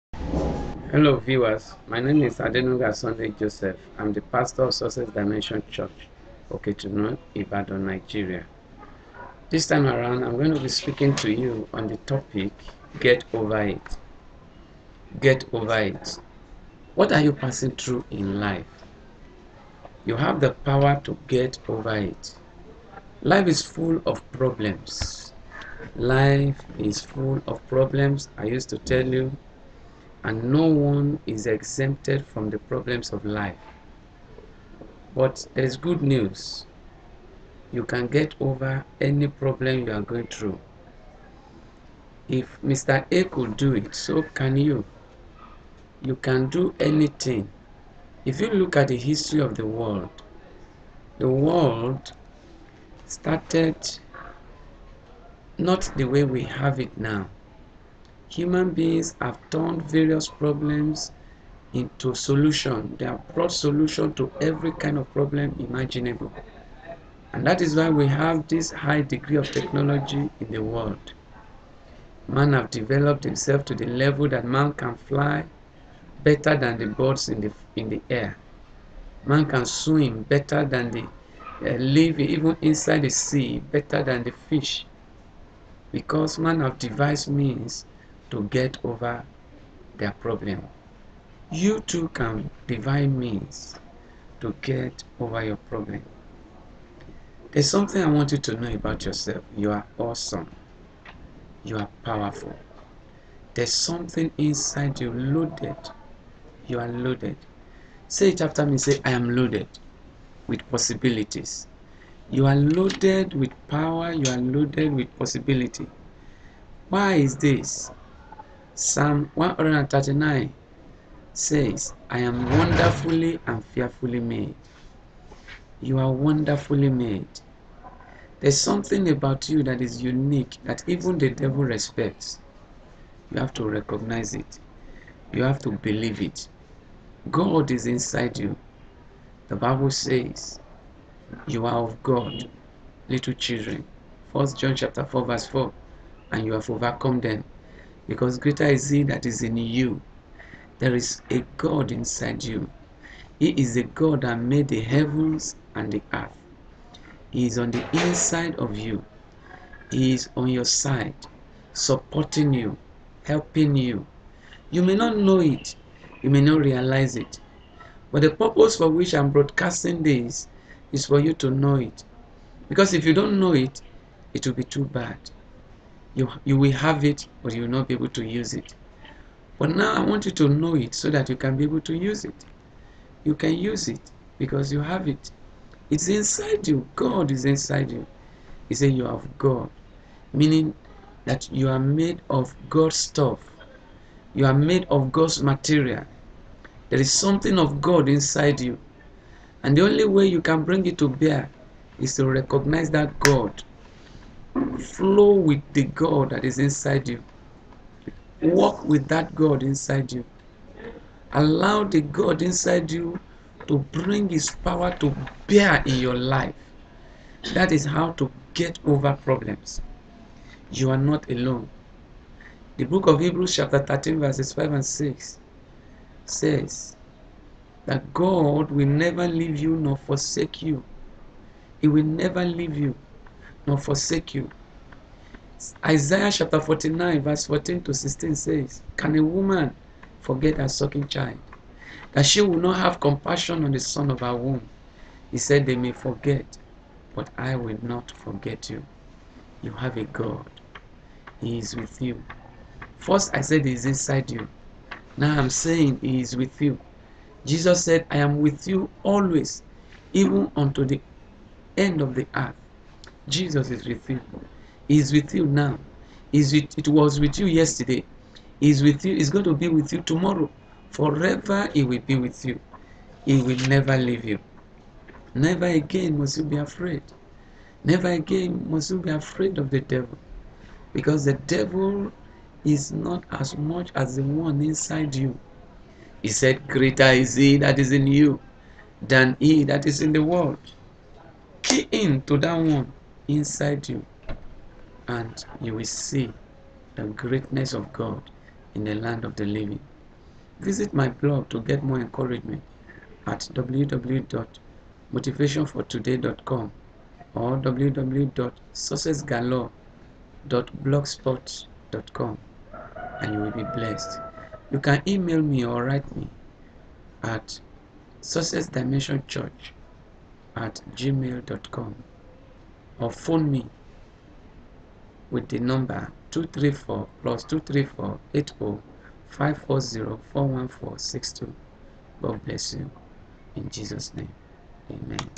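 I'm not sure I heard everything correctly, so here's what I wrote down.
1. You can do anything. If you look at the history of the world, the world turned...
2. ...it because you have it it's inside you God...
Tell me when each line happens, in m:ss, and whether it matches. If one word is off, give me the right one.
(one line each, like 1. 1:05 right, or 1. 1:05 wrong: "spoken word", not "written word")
1. 0:46 wrong: "started", not "turned"
2. 3:03 right.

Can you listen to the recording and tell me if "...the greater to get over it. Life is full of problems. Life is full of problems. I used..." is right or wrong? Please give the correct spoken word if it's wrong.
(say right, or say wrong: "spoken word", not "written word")
wrong: "power", not "greater".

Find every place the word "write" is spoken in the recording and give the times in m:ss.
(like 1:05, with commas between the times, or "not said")
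5:15.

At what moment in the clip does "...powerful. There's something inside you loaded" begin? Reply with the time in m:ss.
1:42.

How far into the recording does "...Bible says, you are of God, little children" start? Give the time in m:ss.
2:19.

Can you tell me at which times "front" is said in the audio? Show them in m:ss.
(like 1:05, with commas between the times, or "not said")
not said.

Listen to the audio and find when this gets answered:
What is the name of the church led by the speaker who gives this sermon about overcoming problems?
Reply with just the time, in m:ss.
0:04.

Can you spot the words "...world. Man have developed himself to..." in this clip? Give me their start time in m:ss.
1:10.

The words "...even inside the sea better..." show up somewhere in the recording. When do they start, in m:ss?
1:22.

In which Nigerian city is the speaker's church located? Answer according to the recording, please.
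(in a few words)
Ibadan.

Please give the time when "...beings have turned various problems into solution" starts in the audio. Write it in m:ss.
0:58.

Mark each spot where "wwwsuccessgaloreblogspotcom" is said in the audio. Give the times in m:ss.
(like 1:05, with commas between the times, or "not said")
5:07.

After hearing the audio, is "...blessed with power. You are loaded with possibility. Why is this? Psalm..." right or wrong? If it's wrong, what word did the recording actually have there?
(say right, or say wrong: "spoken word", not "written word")
wrong: "loaded", not "blessed".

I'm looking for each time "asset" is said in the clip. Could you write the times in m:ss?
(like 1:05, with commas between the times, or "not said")
not said.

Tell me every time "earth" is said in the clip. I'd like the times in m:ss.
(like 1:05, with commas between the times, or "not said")
2:36, 4:22.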